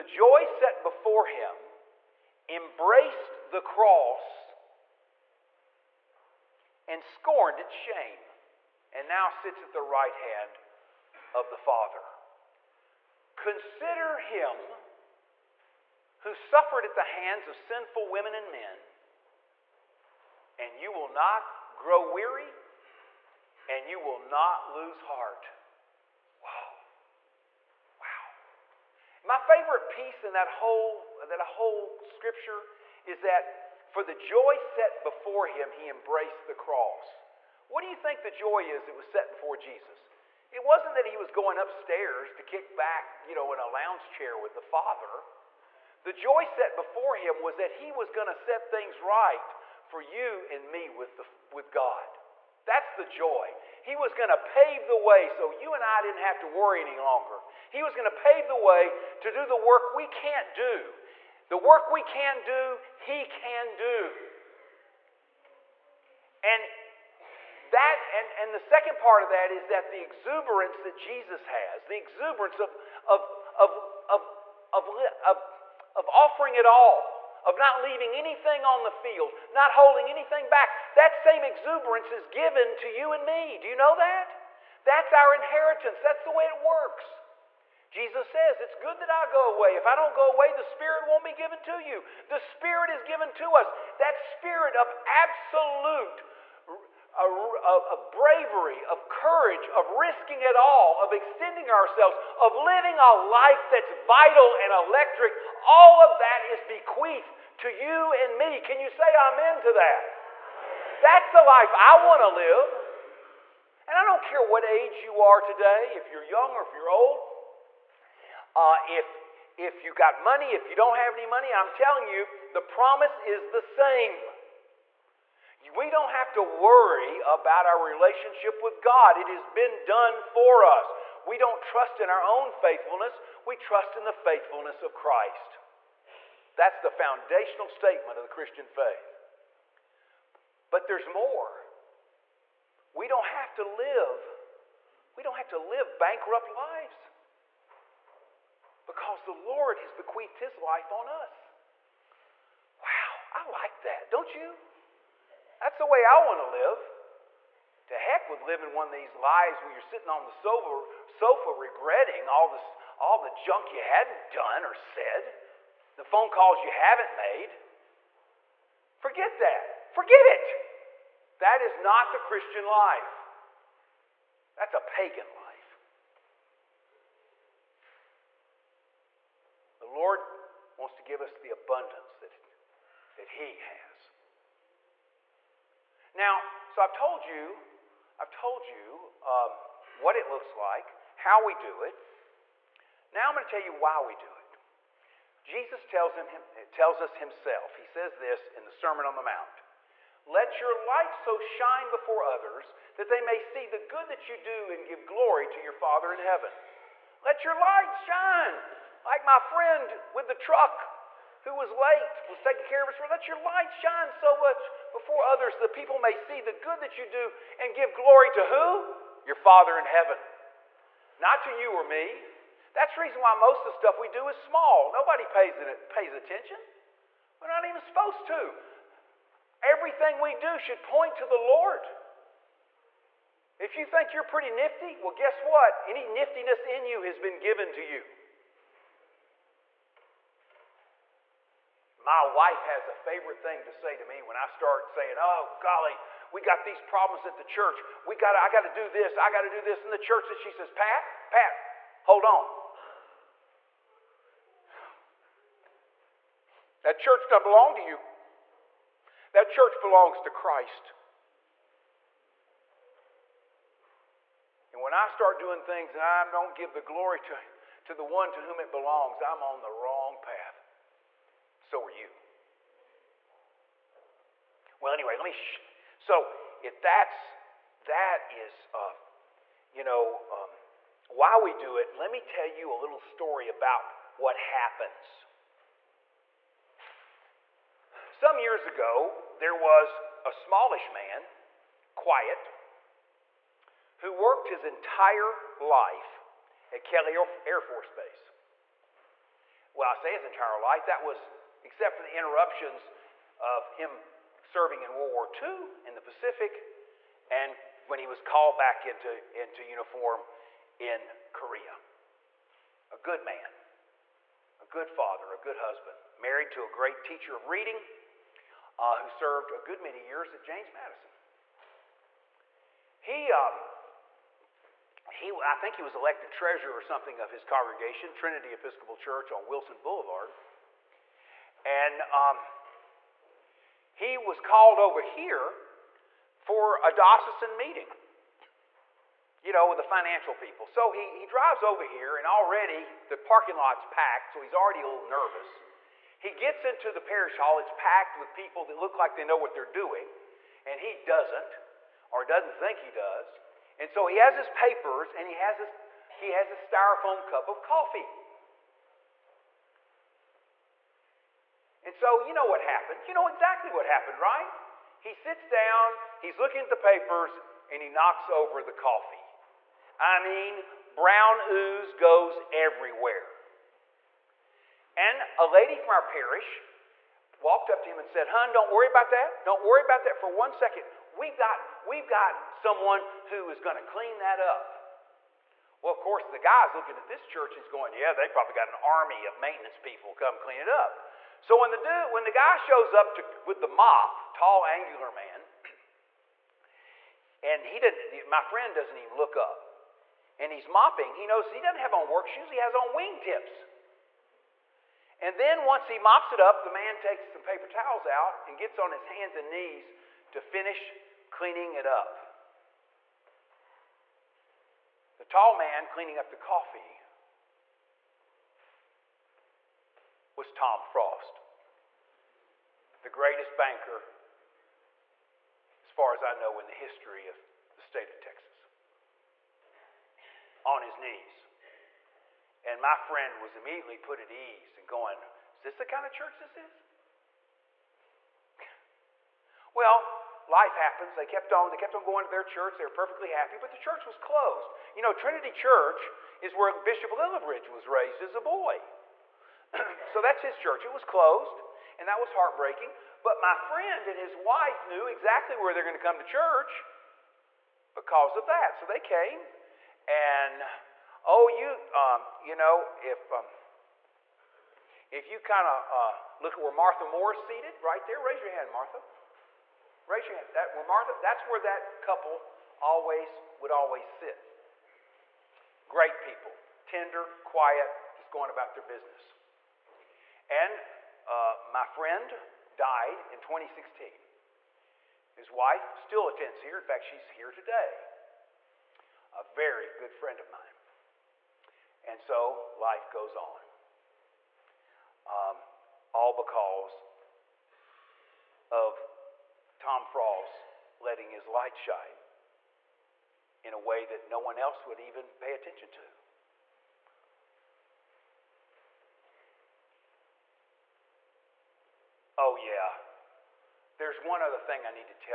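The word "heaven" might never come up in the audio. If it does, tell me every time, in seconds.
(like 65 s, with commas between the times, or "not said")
206 s, 219 s.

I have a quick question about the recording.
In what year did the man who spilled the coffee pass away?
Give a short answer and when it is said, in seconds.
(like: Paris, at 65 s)
2016, at 483 s.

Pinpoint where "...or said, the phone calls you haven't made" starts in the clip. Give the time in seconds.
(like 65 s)
164 s.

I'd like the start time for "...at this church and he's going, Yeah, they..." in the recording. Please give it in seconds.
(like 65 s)
386 s.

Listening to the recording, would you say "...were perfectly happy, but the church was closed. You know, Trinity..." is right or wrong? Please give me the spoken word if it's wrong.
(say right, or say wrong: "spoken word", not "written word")
right.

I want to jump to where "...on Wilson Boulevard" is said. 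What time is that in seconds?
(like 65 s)
329 s.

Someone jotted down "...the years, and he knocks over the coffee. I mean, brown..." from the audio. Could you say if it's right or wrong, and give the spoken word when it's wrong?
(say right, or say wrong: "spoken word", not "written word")
wrong: "papers", not "years".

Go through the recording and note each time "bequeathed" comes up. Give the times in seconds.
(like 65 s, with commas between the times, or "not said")
106 s, 149 s.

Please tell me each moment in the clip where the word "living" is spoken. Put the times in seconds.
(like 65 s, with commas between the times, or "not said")
102 s, 158 s.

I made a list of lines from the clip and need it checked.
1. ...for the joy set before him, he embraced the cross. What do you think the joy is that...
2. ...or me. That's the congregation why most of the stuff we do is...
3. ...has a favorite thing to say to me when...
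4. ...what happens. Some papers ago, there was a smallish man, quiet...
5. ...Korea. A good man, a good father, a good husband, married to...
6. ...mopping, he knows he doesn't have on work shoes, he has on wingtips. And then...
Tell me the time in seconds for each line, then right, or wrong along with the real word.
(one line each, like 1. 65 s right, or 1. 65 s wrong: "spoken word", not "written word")
1. 33 s right
2. 221 s wrong: "reason", not "congregation"
3. 242 s right
4. 284 s wrong: "years", not "papers"
5. 311 s right
6. 400 s right.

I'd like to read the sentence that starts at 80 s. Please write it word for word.
That same exuberance is given to you and me.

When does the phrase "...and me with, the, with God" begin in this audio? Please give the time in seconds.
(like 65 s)
50 s.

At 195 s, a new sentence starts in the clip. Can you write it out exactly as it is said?
Jesus tells, him, tells us himself.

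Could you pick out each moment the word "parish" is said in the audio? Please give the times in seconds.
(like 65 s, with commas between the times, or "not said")
347 s, 376 s.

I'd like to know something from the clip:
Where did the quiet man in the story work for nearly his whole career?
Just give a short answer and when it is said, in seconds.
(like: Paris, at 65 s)
Kelly Air Force Base, at 296 s.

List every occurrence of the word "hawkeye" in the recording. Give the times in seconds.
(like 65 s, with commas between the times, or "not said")
not said.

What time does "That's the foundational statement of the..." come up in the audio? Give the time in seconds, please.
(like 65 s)
136 s.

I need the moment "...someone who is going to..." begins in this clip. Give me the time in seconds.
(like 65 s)
382 s.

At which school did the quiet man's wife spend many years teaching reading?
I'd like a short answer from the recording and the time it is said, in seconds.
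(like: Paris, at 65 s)
James Madison, at 320 s.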